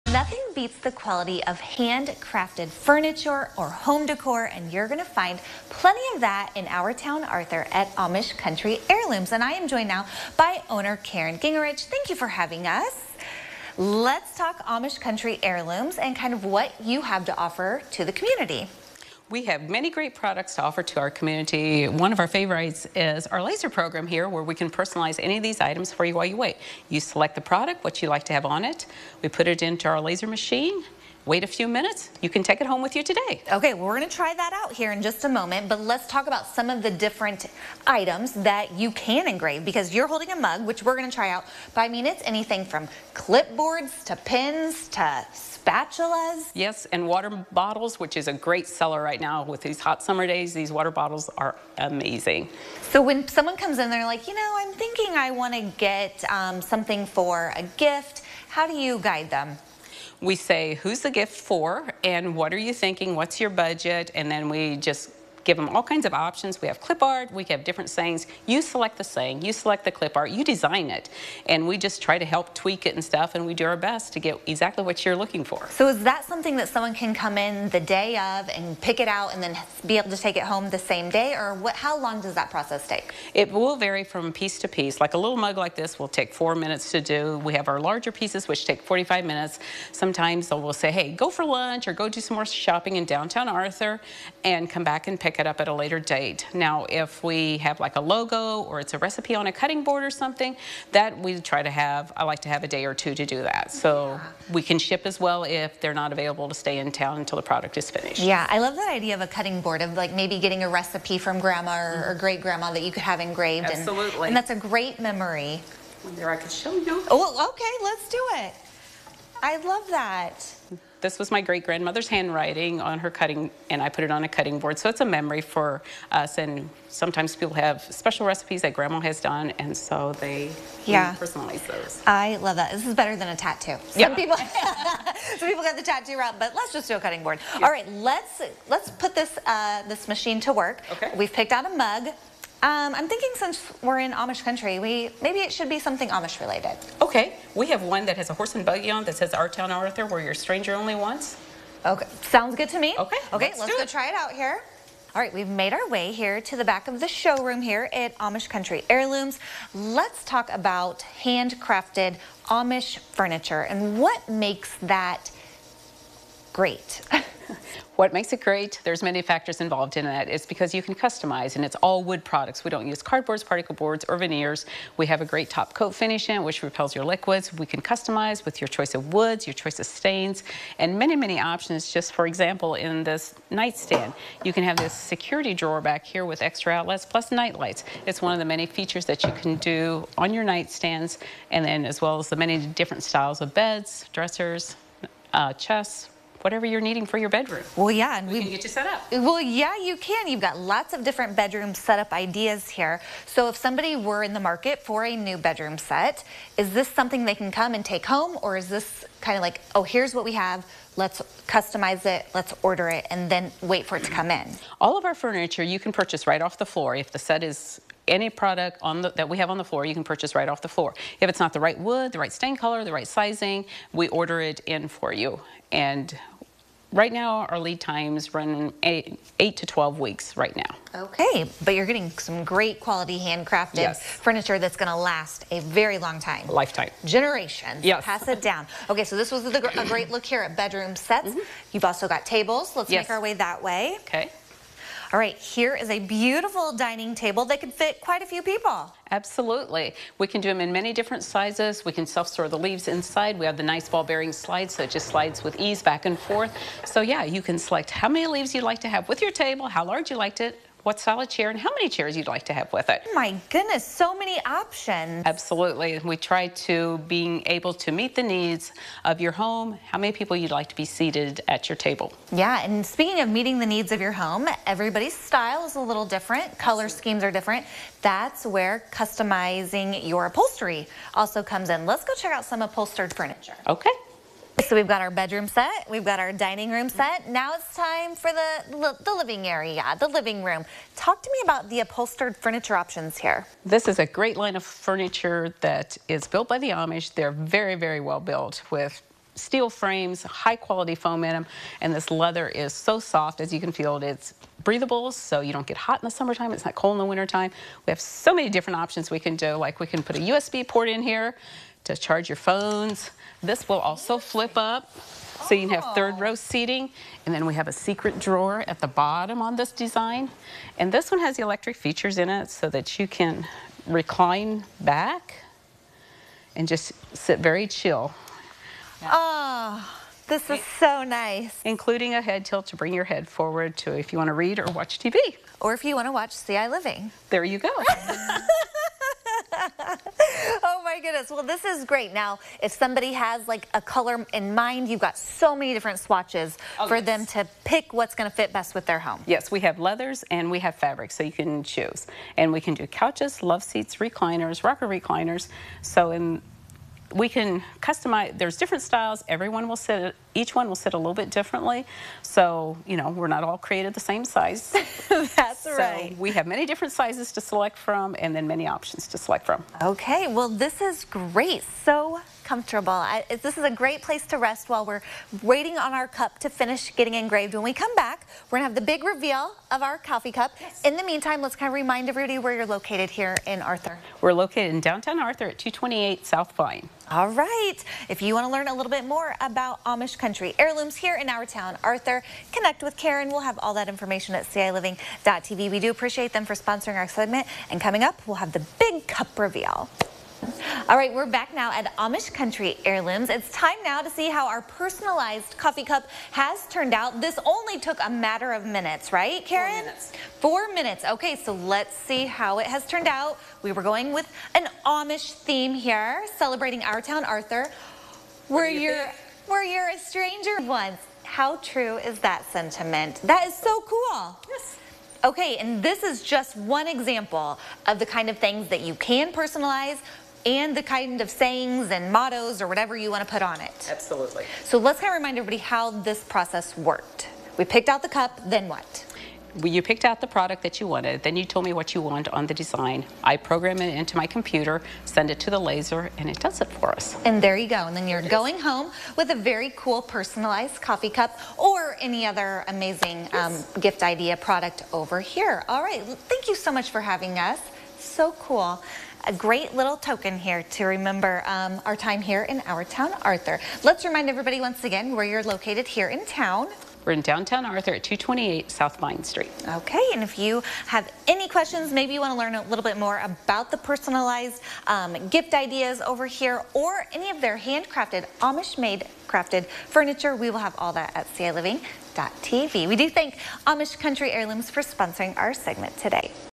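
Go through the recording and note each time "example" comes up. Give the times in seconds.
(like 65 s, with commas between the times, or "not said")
182 s, 426 s.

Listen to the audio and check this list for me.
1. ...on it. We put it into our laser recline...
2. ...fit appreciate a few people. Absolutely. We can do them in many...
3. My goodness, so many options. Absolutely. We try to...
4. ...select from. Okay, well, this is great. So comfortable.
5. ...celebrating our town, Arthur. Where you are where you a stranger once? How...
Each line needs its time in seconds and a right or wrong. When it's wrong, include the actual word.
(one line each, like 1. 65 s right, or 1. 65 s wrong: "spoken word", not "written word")
1. 28 s wrong: "machine", not "recline"
2. 247 s wrong: "quite", not "appreciate"
3. 263 s right
4. 369 s right
5. 416 s right.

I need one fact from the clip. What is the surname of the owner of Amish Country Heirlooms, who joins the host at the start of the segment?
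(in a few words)
Gingerich.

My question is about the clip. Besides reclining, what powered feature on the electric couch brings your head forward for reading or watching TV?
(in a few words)
Head tilt.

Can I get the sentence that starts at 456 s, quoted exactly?
Thank you so much for having us.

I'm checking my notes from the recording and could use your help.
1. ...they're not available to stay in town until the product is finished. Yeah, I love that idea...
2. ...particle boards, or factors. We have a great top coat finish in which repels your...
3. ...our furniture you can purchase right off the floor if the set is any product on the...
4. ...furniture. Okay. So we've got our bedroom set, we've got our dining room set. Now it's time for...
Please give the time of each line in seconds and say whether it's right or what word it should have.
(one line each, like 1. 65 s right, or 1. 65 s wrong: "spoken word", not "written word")
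1. 105 s right
2. 173 s wrong: "veneers", not "factors"
3. 215 s right
4. 283 s right.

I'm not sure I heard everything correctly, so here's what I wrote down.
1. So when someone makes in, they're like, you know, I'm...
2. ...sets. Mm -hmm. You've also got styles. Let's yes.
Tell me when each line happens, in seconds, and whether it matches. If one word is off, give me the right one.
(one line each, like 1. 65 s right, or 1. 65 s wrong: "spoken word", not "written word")
1. 52 s wrong: "comes", not "makes"
2. 240 s wrong: "tables", not "styles".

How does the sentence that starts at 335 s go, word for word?
Or if you want to watch CI Living.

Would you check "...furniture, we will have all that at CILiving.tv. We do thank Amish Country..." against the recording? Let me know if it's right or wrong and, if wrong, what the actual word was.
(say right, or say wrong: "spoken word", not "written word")
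right.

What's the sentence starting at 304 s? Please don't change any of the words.
It's breathable, so you don't get hot in the summertime.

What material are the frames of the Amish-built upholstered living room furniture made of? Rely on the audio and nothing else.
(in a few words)
Steel.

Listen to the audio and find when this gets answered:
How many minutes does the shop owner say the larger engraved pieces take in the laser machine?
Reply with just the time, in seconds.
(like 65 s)
88 s.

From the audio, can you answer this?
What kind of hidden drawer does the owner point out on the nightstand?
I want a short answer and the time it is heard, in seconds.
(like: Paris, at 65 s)
Security drawer, at 184 s.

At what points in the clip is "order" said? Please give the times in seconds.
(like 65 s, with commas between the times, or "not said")
212 s, 224 s.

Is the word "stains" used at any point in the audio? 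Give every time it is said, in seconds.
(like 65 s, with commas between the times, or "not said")
179 s, 222 s.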